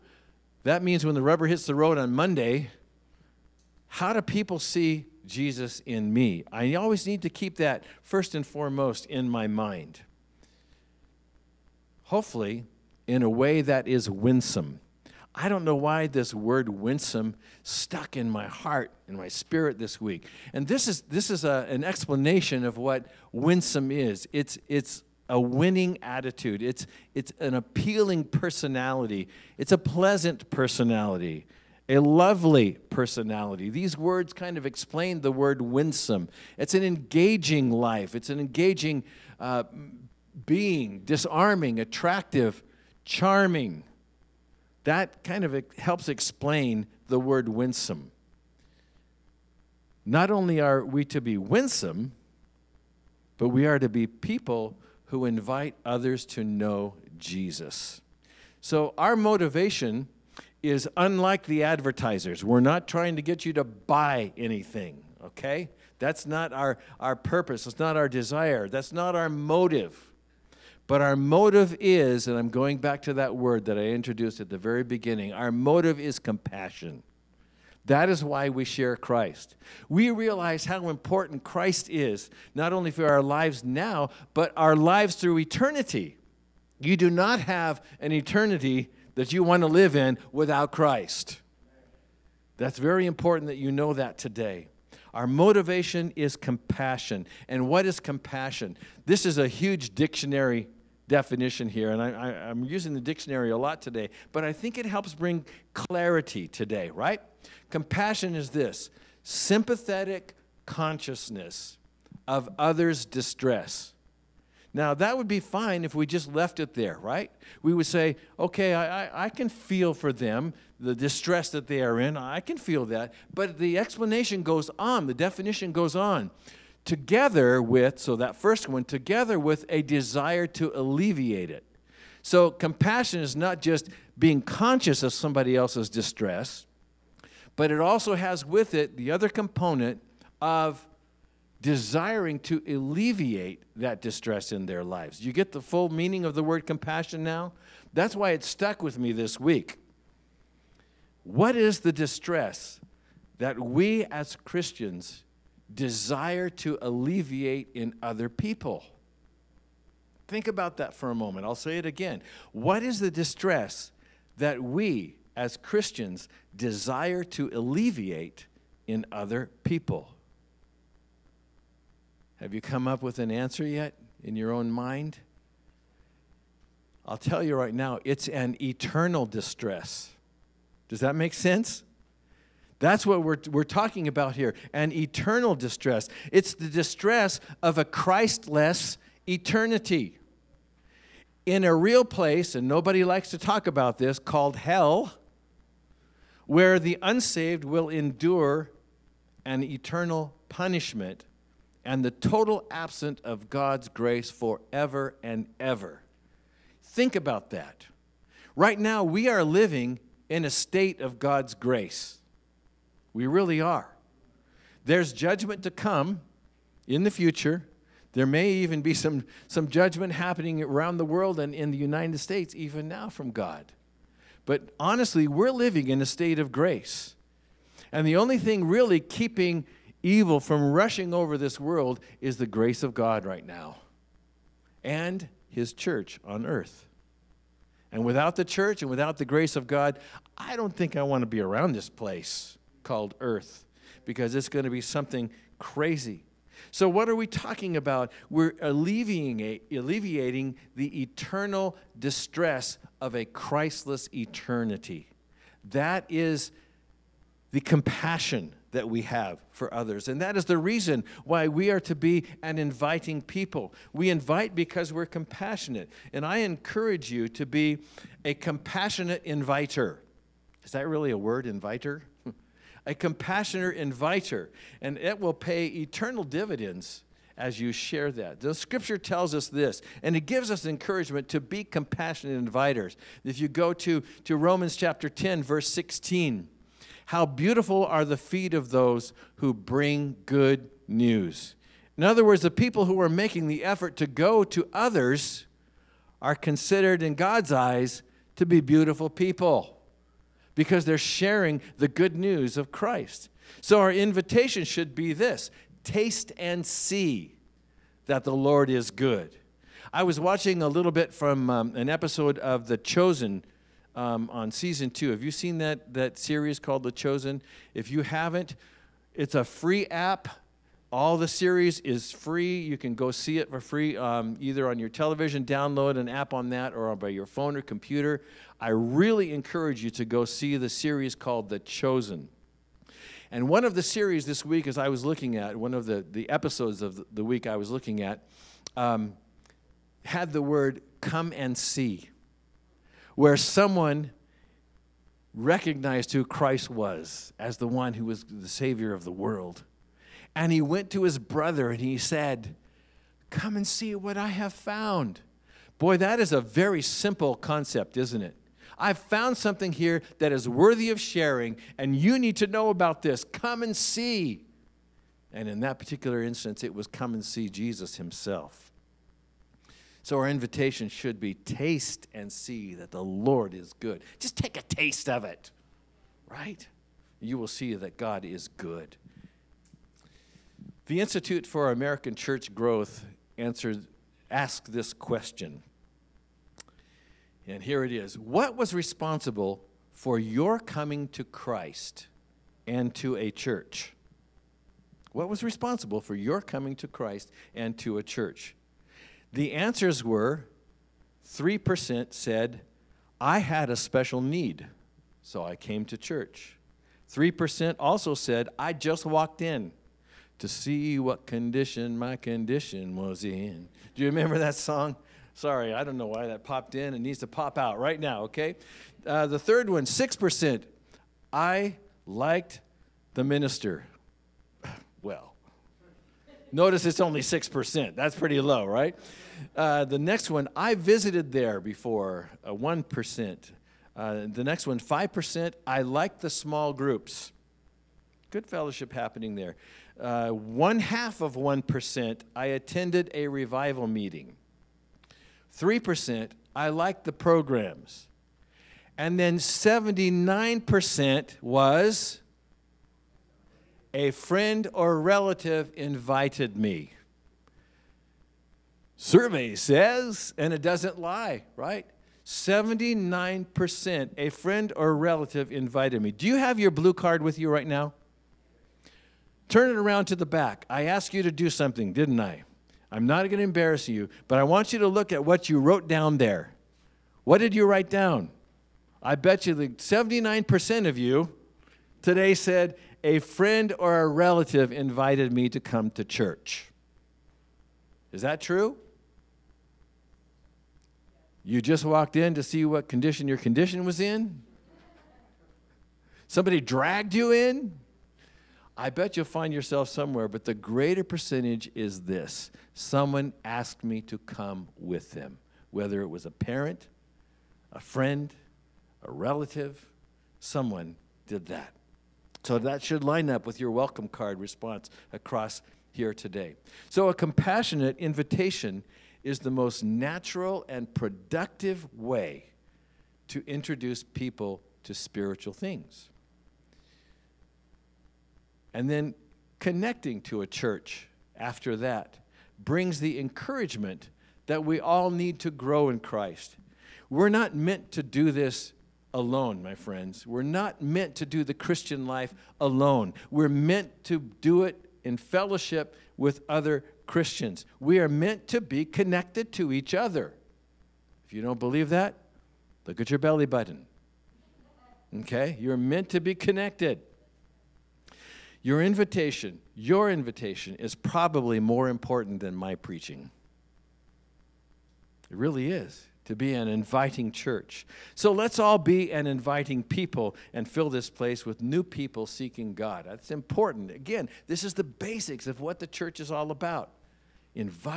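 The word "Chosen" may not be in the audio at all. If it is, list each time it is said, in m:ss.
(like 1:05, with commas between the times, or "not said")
5:12, 5:16, 5:31.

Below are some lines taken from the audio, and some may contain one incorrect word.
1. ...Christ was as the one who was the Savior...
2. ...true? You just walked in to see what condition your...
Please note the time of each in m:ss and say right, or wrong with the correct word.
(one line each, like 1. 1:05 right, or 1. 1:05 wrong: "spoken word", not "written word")
1. 5:46 right
2. 8:08 right.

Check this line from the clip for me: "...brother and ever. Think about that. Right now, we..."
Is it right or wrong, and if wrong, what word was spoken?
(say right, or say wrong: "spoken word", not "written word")
wrong: "forever", not "brother".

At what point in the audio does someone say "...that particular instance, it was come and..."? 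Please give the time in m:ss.
6:05.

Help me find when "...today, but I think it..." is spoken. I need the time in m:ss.
1:43.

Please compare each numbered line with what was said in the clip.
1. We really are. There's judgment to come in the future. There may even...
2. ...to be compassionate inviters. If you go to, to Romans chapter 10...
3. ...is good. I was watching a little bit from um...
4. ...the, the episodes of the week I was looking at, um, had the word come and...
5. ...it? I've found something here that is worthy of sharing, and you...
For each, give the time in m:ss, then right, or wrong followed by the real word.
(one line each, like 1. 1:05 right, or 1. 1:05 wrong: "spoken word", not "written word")
1. 3:33 right
2. 4:41 right
3. 5:08 right
4. 5:35 right
5. 5:58 right.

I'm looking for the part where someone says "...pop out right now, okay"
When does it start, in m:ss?
6:57.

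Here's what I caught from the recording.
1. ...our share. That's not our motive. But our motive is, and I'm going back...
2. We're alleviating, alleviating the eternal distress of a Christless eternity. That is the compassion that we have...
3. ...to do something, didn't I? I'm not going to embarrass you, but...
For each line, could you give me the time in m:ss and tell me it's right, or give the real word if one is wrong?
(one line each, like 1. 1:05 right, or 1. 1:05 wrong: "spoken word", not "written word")
1. 1:07 wrong: "desire", not "share"
2. 4:08 right
3. 7:51 right.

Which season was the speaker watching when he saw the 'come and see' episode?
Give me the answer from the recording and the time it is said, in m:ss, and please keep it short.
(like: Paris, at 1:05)
season 2, at 5:14.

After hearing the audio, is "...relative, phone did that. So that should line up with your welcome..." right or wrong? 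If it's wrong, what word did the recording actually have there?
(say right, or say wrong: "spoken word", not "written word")
wrong: "someone", not "phone".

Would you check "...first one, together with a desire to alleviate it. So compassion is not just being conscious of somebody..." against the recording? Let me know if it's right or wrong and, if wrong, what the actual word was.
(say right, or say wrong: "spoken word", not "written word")
right.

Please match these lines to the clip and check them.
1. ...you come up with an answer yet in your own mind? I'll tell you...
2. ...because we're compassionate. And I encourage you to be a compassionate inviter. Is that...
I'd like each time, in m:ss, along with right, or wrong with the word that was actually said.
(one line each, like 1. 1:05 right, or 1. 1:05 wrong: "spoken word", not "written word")
1. 2:52 right
2. 4:24 right.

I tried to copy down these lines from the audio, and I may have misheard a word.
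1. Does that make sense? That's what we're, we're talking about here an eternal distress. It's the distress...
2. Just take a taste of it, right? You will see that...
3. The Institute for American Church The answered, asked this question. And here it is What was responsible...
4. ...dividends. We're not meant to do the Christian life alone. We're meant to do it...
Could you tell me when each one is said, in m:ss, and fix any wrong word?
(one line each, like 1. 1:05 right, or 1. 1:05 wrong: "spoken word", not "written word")
1. 3:00 right
2. 6:14 right
3. 6:20 wrong: "Growth", not "The"
4. 8:59 wrong: "friends", not "dividends".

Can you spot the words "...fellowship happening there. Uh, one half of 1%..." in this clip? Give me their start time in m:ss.
7:18.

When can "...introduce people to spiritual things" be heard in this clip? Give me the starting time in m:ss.
8:43.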